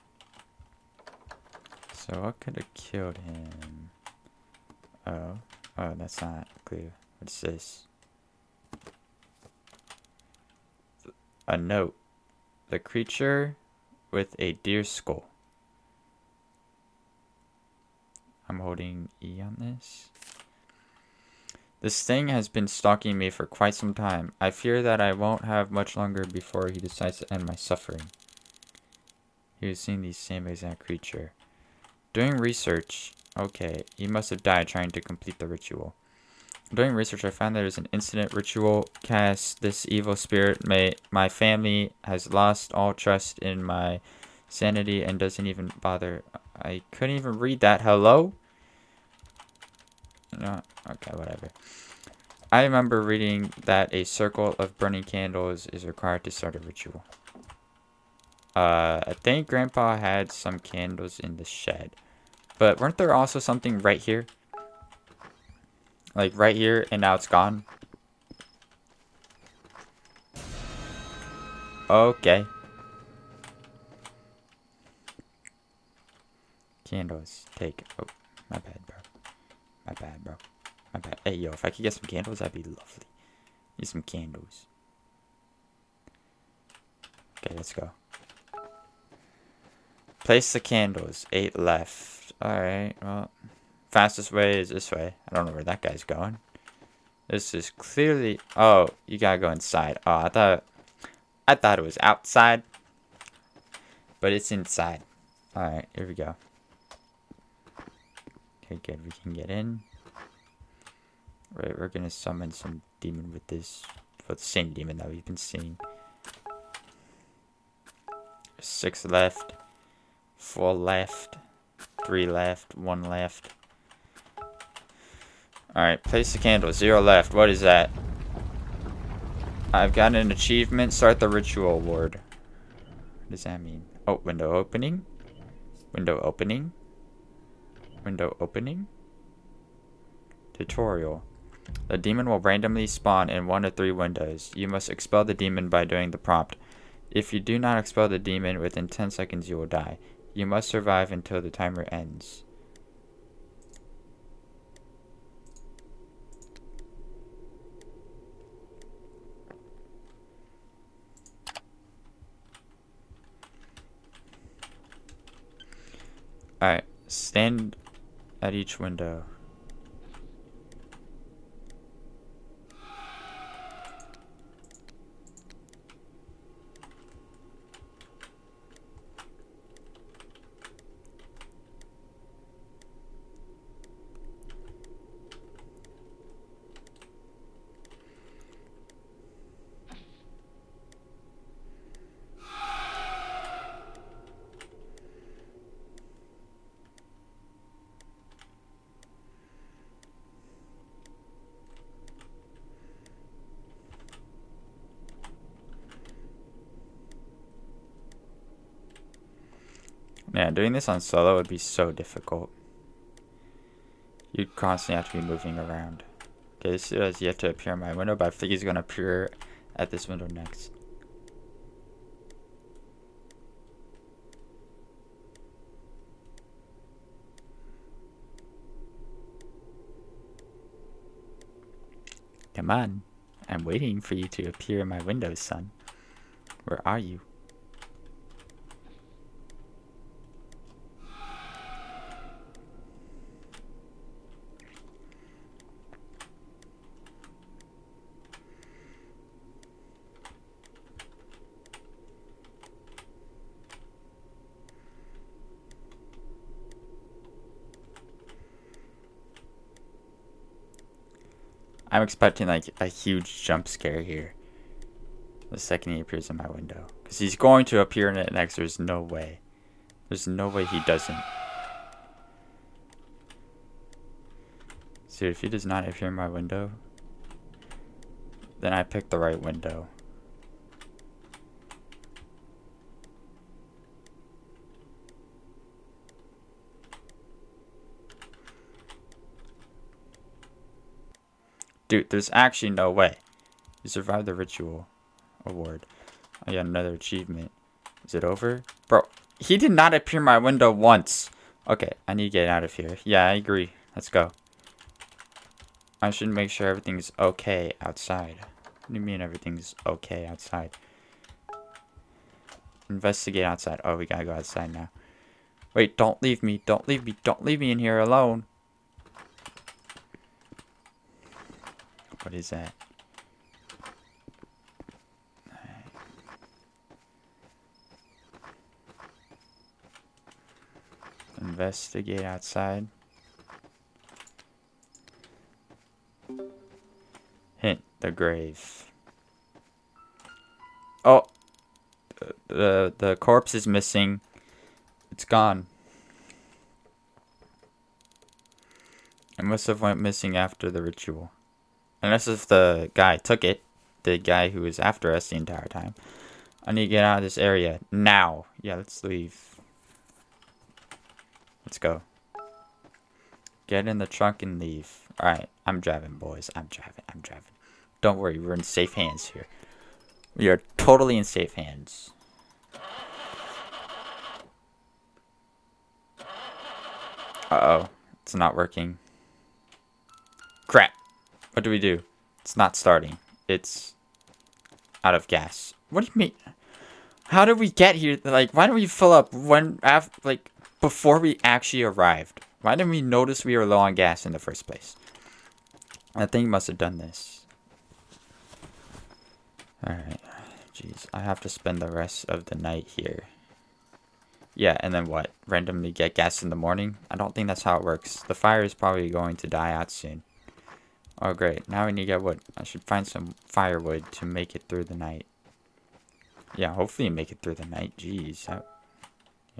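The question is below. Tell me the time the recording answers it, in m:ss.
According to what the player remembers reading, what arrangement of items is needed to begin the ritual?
0:54.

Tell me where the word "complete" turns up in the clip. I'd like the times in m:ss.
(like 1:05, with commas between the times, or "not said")
0:35.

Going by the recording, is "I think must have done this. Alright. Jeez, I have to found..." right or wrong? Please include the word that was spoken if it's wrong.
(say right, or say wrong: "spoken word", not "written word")
wrong: "spend", not "found".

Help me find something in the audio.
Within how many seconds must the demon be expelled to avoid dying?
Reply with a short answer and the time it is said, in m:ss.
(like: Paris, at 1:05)
10, at 2:28.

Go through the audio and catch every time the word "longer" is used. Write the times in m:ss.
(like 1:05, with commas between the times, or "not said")
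0:25.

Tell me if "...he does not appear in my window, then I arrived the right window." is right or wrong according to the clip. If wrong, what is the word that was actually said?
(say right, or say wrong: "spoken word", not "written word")
wrong: "picked", not "arrived".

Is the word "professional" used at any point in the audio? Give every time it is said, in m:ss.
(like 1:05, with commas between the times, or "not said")
not said.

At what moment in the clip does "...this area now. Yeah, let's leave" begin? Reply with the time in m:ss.
5:57.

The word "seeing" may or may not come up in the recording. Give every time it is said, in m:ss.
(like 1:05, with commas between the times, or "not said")
0:29, 1:55.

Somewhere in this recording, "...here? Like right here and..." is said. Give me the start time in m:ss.
1:04.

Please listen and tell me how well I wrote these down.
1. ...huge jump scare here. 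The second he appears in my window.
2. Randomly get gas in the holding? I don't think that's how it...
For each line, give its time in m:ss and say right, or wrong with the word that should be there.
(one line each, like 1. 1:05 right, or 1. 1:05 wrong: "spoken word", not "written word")
1. 4:22 right
2. 6:45 wrong: "morning", not "holding".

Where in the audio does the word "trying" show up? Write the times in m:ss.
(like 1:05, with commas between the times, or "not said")
0:34.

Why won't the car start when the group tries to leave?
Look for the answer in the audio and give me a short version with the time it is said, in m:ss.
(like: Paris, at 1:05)
Out of gas, at 6:25.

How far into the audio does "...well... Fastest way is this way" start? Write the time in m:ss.
1:33.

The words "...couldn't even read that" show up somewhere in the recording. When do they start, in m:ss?
0:46.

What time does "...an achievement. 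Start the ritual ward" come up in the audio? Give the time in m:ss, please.
2:10.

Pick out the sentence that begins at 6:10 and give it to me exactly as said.
We are totally in safe hands.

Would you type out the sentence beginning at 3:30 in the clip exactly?
doing this on solo would be so difficult.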